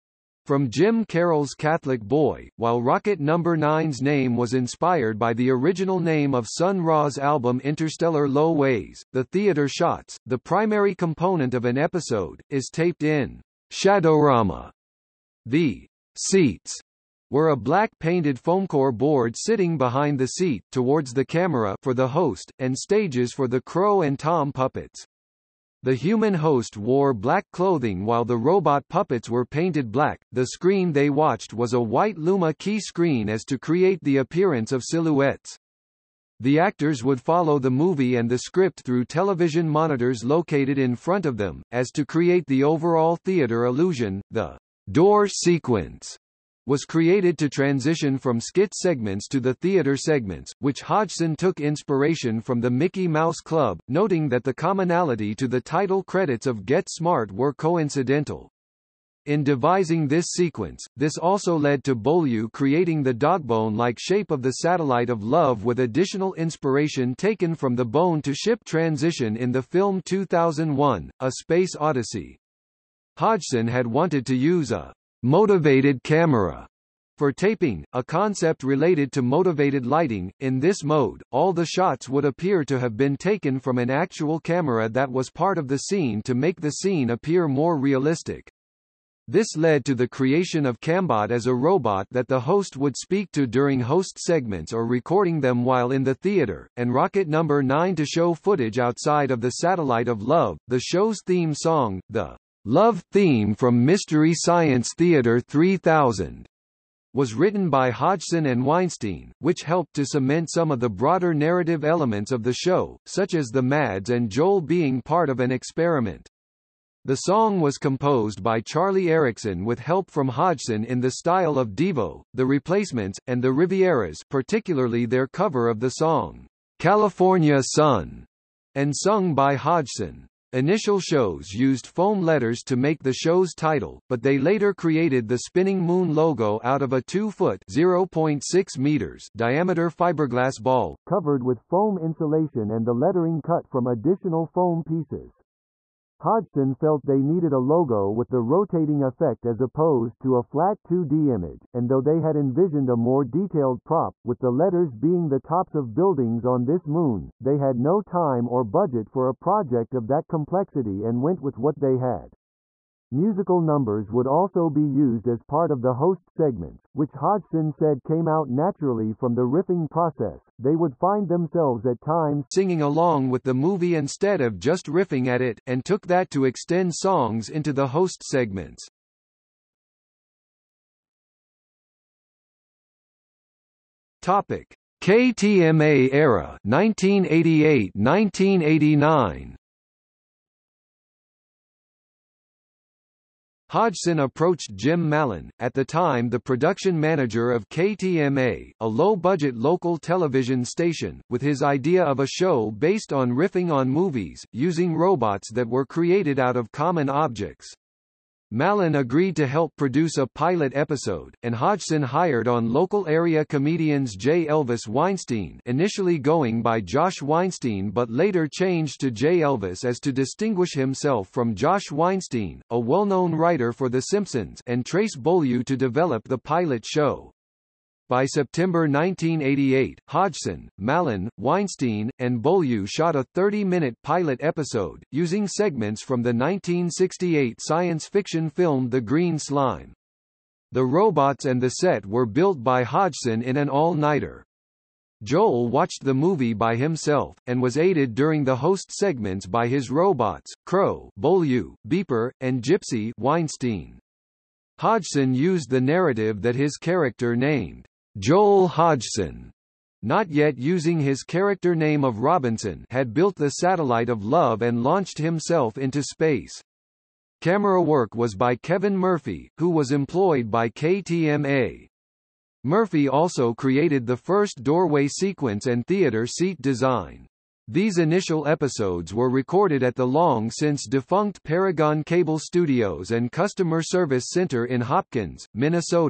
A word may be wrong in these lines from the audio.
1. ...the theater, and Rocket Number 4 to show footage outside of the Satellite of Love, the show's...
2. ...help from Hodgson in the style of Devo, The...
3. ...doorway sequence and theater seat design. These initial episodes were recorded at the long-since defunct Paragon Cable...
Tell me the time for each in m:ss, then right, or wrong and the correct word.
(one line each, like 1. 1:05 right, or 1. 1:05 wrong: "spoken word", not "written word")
1. 1:36 wrong: "9", not "4"
2. 1:59 right
3. 4:34 right.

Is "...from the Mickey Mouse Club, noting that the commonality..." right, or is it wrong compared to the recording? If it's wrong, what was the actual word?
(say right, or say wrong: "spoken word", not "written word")
right.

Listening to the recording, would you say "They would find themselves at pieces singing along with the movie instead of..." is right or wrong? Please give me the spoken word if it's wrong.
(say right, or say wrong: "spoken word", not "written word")
wrong: "times", not "pieces".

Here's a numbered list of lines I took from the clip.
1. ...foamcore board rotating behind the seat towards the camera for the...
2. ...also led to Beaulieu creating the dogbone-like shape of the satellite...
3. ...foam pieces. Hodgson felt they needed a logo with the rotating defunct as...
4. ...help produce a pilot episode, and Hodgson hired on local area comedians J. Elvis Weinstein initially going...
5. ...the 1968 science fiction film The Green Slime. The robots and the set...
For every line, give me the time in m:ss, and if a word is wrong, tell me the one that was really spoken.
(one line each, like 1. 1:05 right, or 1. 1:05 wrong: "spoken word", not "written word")
1. 0:18 wrong: "sitting", not "rotating"
2. 1:01 right
3. 2:24 wrong: "effect", not "defunct"
4. 3:29 right
5. 3:56 right.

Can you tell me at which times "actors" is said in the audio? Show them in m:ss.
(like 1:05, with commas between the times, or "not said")
0:36.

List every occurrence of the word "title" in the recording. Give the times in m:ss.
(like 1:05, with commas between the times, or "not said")
0:55, 2:13.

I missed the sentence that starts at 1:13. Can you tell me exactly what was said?
Hodgson had wanted to use a motivated camera for taping, a concept related to motivated lighting.